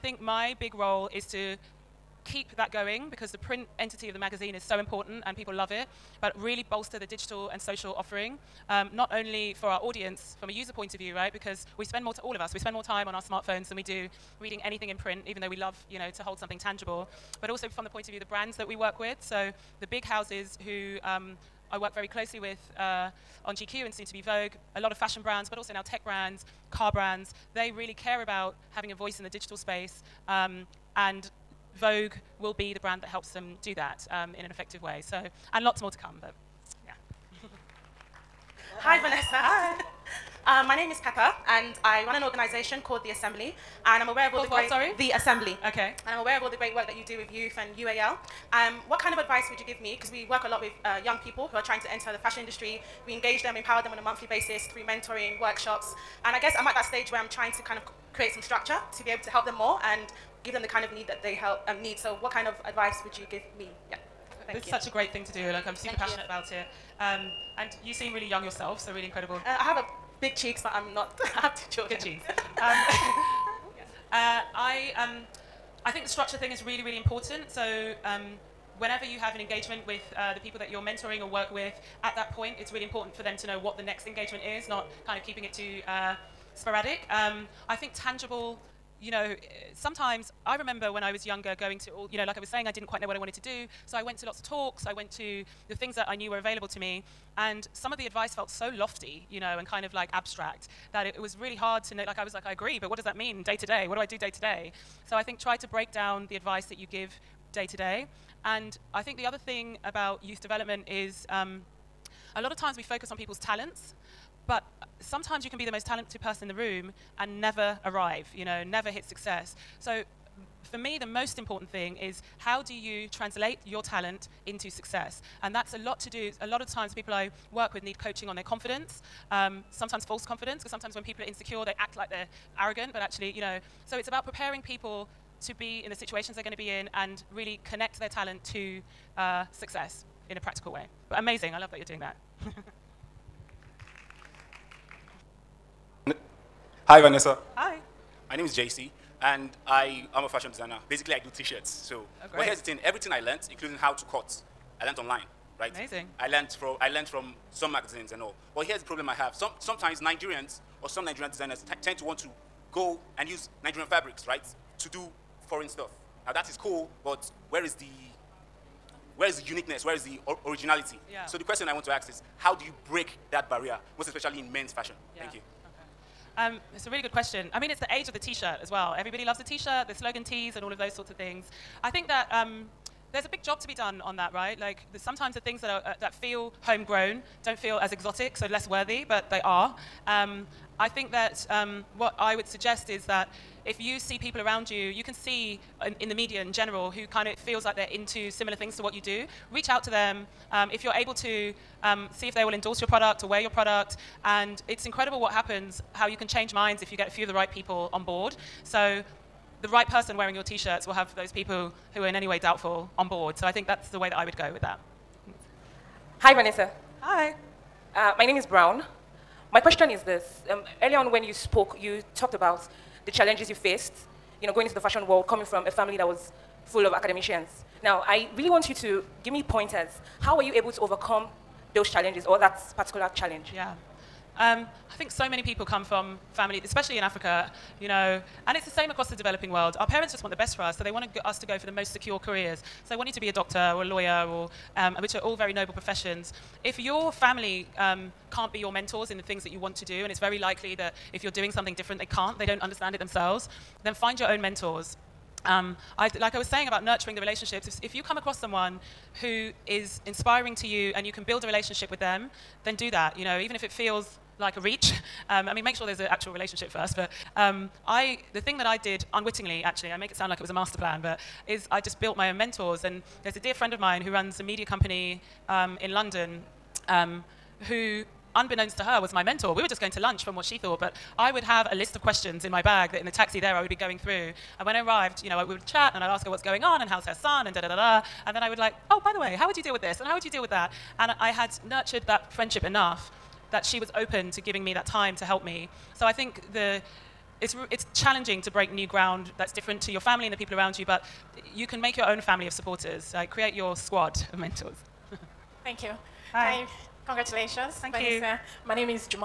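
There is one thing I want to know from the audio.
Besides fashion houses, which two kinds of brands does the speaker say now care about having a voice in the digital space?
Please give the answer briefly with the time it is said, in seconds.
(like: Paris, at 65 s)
tech brands, car brands, at 25 s.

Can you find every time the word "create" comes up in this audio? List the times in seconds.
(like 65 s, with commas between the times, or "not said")
58 s, 303 s.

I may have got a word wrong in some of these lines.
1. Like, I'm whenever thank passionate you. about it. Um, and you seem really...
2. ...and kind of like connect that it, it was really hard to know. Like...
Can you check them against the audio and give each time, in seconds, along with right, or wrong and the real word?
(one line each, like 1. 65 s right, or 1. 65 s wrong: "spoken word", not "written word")
1. 65 s wrong: "super", not "whenever"
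2. 99 s wrong: "abstract", not "connect".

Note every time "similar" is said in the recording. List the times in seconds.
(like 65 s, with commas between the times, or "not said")
198 s.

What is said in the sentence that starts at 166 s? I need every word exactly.
Now that is cool, but where is the where is the uniqueness?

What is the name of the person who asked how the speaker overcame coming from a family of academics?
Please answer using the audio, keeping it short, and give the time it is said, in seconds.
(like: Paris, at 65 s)
Brown, at 218 s.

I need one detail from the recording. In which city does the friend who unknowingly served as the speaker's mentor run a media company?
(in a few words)
London.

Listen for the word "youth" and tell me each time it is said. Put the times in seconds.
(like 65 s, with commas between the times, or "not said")
47 s, 110 s.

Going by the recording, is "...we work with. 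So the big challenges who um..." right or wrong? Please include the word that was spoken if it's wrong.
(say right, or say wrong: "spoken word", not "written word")
wrong: "houses", not "challenges".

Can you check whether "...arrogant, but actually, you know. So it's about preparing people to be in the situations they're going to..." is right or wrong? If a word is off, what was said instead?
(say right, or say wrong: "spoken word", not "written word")
right.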